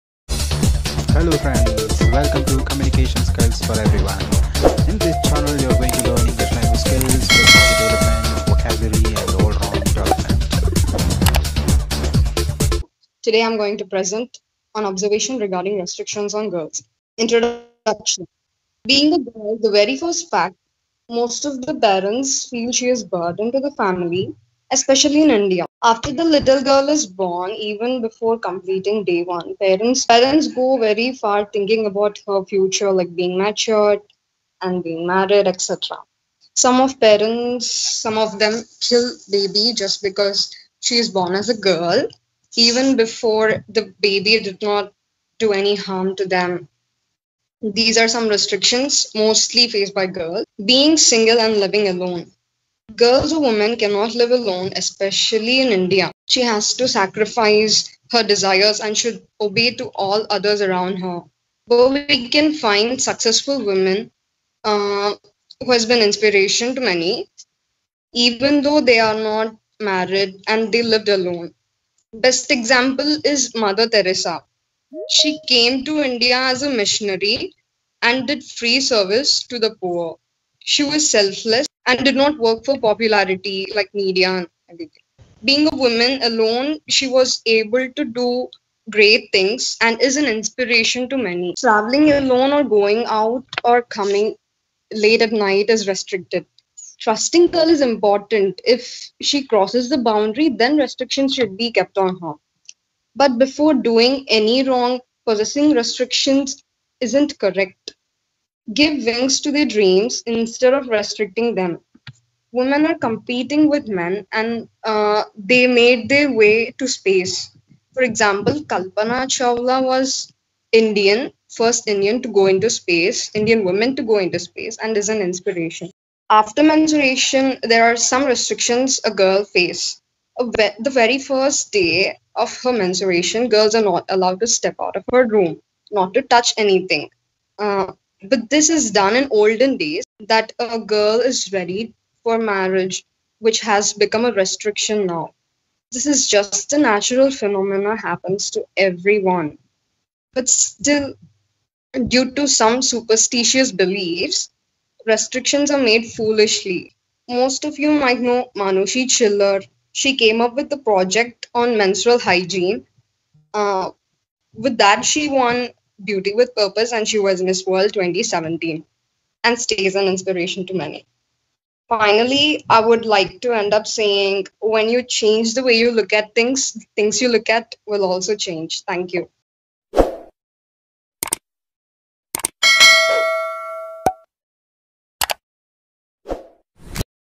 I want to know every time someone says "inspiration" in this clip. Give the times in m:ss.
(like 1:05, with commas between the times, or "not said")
1:06, 1:30, 2:05, 2:50.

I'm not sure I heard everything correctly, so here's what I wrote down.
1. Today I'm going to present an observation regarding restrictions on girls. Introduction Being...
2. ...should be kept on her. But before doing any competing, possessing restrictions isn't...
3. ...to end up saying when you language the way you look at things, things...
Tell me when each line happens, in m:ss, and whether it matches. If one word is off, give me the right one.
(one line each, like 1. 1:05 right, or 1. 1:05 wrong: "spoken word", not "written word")
1. 0:13 right
2. 1:41 wrong: "wrong", not "competing"
3. 2:53 wrong: "change", not "language".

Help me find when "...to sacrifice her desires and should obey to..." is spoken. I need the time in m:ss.
0:56.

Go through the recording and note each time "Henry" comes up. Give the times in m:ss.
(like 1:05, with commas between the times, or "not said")
not said.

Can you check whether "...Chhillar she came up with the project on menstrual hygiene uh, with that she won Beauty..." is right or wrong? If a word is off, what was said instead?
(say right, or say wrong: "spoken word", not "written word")
right.